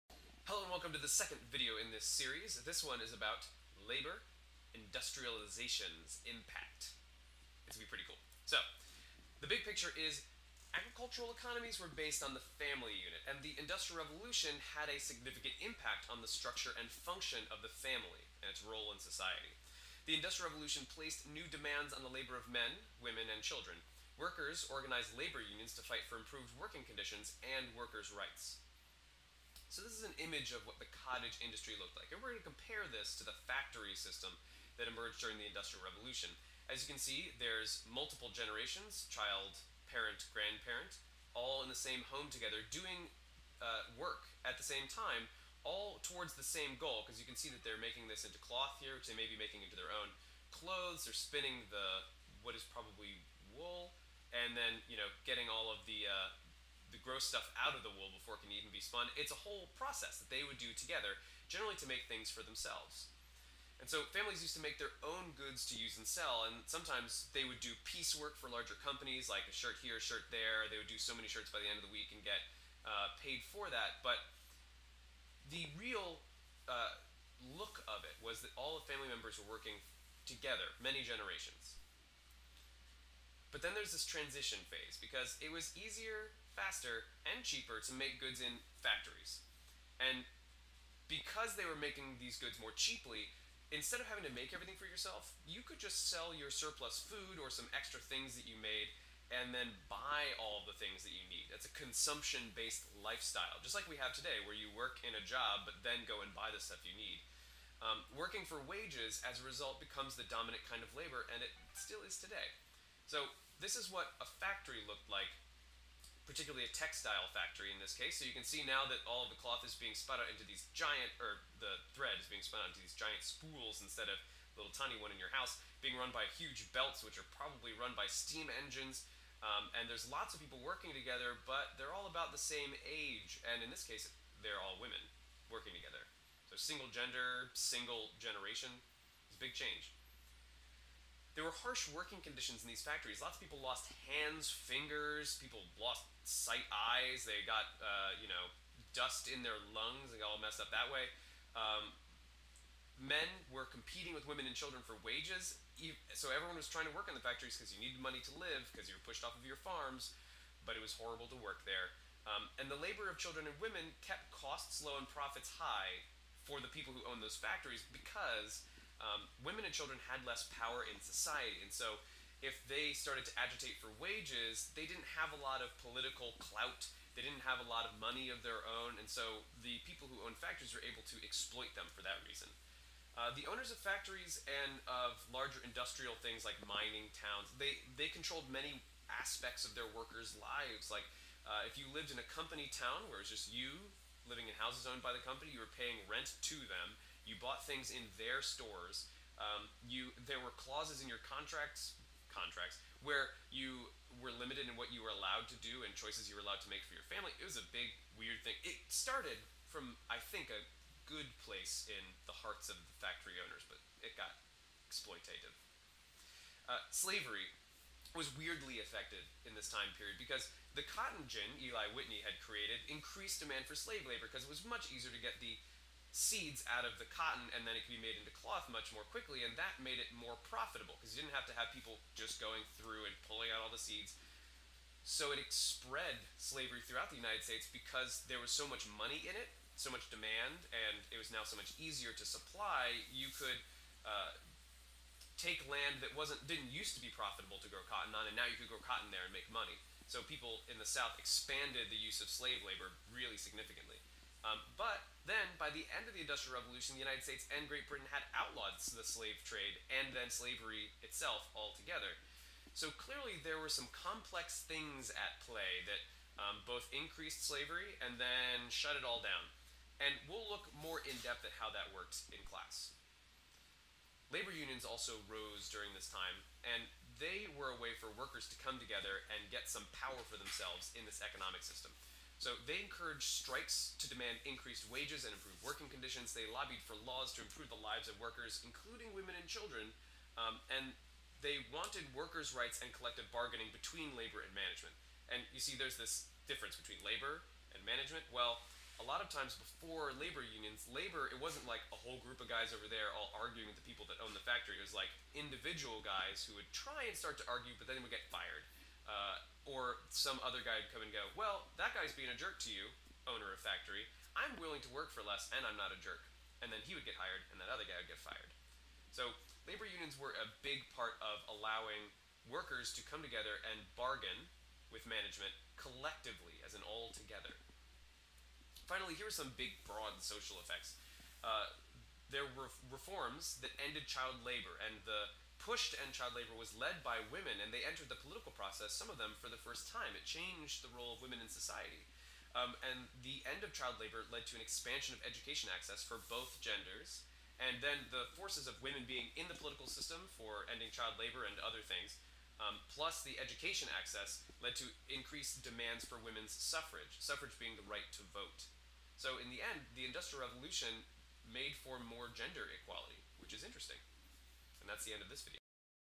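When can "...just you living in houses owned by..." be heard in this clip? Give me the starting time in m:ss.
3:13.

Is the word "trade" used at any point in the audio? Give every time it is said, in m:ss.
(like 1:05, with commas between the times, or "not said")
4:19.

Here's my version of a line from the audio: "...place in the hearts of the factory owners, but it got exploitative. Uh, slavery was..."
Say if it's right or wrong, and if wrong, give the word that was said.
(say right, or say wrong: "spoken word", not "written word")
right.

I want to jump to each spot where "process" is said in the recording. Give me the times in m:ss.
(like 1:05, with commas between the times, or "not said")
0:59, 5:38.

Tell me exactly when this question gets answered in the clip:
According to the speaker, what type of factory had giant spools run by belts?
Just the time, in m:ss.
1:56.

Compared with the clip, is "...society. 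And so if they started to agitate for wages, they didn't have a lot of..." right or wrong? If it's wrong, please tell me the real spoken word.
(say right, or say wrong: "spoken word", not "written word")
right.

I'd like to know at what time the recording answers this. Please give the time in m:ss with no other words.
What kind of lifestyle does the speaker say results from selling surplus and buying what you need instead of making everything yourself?
1:41.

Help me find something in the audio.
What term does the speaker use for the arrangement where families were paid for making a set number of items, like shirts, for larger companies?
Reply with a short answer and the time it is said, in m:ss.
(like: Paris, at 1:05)
Piecework, at 1:07.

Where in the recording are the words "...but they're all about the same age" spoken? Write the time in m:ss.
2:11.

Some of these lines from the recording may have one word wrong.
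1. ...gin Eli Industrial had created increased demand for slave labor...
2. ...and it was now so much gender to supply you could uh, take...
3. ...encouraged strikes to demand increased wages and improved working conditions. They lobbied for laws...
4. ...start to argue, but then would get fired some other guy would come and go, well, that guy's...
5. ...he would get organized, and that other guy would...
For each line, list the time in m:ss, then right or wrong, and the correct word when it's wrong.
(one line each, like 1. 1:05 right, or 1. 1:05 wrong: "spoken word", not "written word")
1. 3:41 wrong: "Whitney", not "Industrial"
2. 4:00 wrong: "easier", not "gender"
3. 4:42 right
4. 5:07 right
5. 5:16 wrong: "hired", not "organized".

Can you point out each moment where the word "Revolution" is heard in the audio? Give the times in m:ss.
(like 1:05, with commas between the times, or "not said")
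0:14, 0:20, 0:35, 4:16, 6:00.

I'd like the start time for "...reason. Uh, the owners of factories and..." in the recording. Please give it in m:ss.
3:02.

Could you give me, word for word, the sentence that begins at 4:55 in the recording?
And you see, there's this difference between labor and management.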